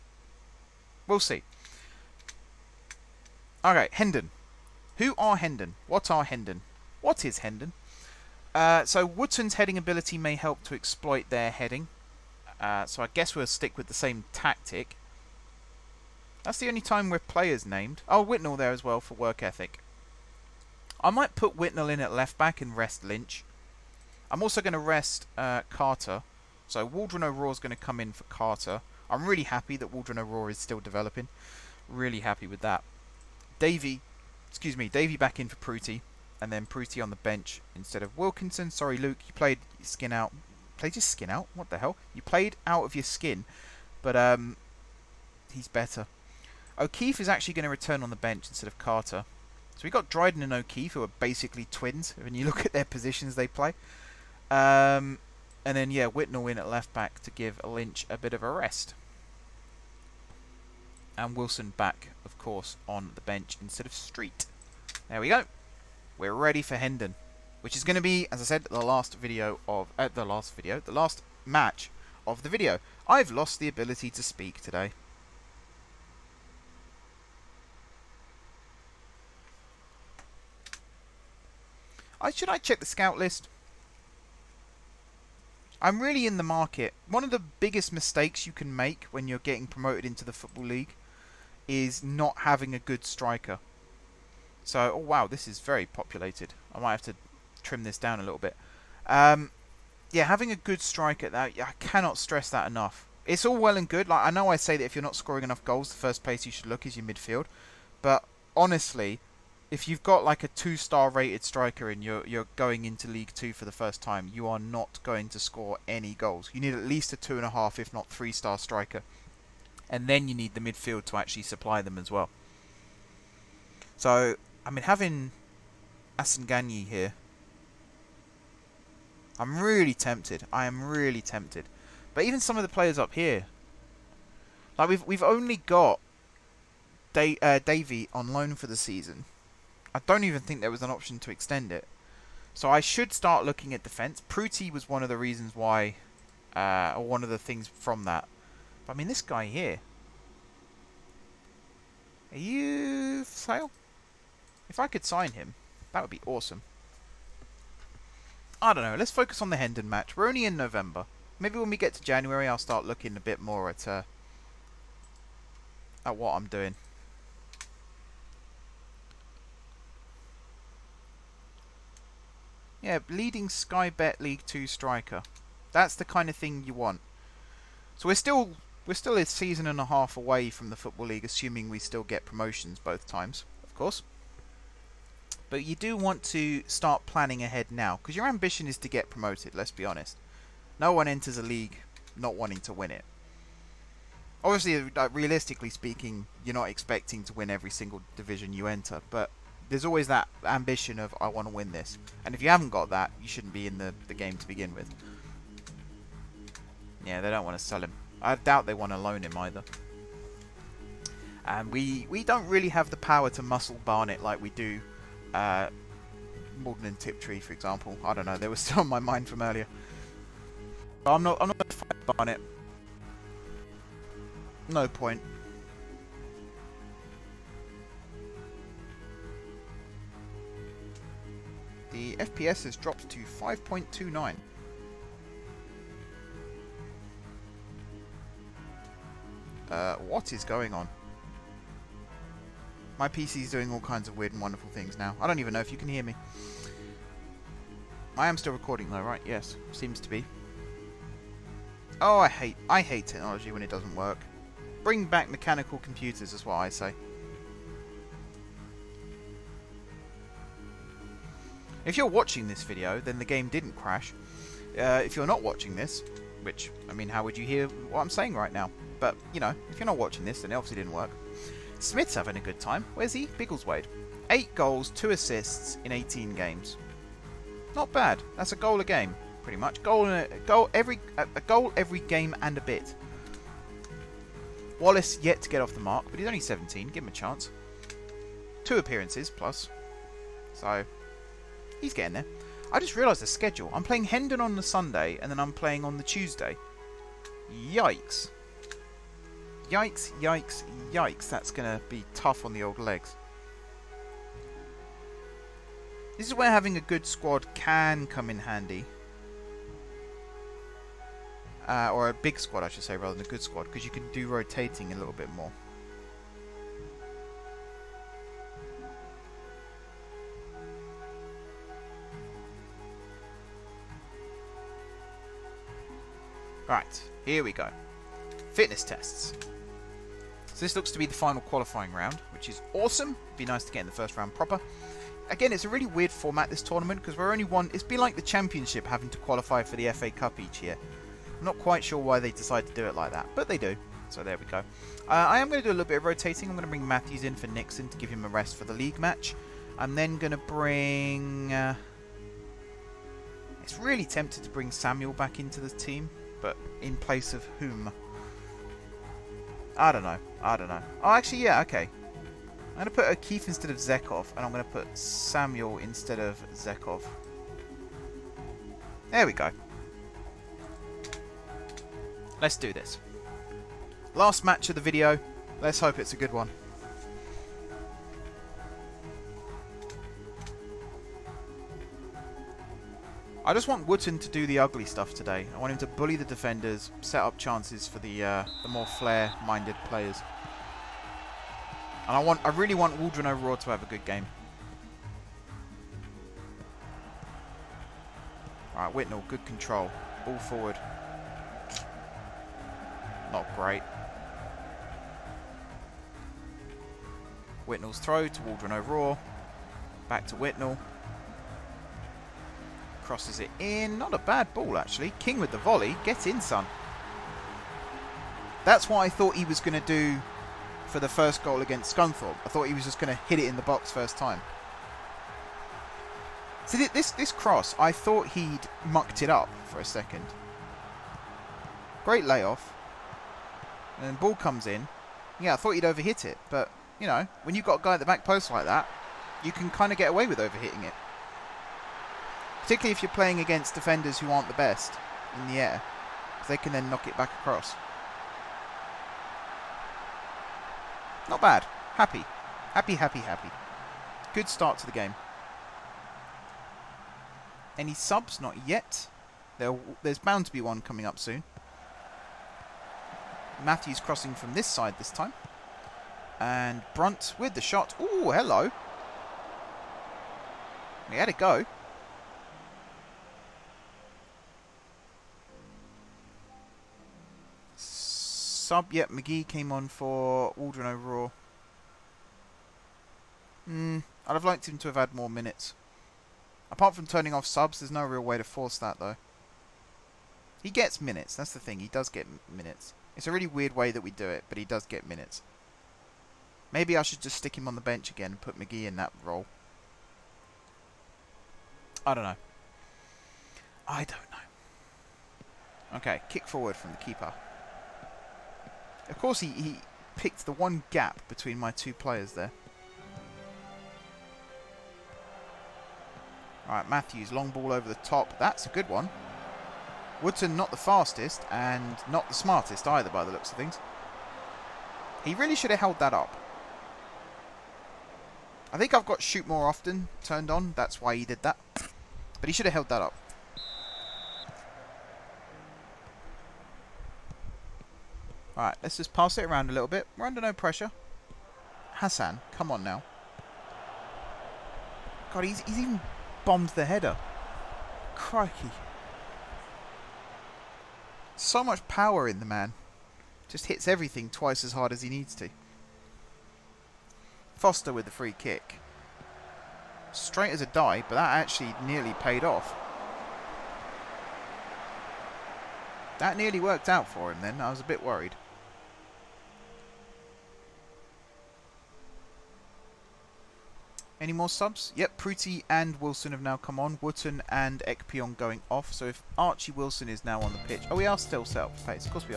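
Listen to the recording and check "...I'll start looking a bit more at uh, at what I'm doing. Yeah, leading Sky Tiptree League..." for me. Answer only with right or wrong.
wrong.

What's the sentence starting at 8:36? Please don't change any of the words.
Alright, Matthews, long ball over the top.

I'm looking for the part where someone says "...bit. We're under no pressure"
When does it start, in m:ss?
8:59.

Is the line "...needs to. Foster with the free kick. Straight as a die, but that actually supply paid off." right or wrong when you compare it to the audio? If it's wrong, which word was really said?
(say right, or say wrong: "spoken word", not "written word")
wrong: "nearly", not "supply".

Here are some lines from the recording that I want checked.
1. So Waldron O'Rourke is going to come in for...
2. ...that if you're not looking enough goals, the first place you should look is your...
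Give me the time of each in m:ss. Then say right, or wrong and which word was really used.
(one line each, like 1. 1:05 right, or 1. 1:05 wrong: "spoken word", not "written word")
1. 0:26 right
2. 1:44 wrong: "scoring", not "looking".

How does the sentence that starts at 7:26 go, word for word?
They can then knock it back across.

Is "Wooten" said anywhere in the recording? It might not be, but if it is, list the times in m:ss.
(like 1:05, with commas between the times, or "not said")
6:23, 9:37.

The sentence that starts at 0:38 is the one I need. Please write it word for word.
Sorry, Luke, you played skin out.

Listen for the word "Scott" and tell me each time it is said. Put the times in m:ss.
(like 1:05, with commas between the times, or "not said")
not said.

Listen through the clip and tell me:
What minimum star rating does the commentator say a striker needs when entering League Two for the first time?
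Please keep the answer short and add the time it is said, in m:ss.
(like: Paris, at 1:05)
two and a half, at 1:57.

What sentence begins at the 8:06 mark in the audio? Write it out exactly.
Apart from turning off subs, there's no real way to force that, though.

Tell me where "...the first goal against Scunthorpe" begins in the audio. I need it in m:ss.
7:00.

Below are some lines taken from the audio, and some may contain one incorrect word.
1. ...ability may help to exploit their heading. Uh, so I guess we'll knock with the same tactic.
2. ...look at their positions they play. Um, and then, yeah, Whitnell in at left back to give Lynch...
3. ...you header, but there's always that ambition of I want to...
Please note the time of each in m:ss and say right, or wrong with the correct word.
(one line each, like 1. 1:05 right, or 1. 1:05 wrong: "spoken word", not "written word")
1. 0:09 wrong: "stick", not "knock"
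2. 0:52 right
3. 3:18 wrong: "enter", not "header".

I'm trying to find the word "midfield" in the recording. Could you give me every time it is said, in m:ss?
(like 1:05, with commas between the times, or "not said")
1:47, 2:00.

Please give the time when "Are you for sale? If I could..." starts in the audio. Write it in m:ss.
2:32.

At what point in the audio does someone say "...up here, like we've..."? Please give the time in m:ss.
2:12.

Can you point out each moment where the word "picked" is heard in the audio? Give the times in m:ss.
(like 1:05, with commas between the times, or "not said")
8:30.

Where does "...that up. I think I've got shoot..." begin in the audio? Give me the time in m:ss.
8:45.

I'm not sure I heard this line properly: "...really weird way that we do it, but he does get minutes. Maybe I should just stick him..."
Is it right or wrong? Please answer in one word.
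right.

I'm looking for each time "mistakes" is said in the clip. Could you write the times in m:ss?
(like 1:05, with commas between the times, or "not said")
1:27.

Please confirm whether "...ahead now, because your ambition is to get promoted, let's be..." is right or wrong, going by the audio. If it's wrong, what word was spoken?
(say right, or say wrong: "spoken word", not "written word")
right.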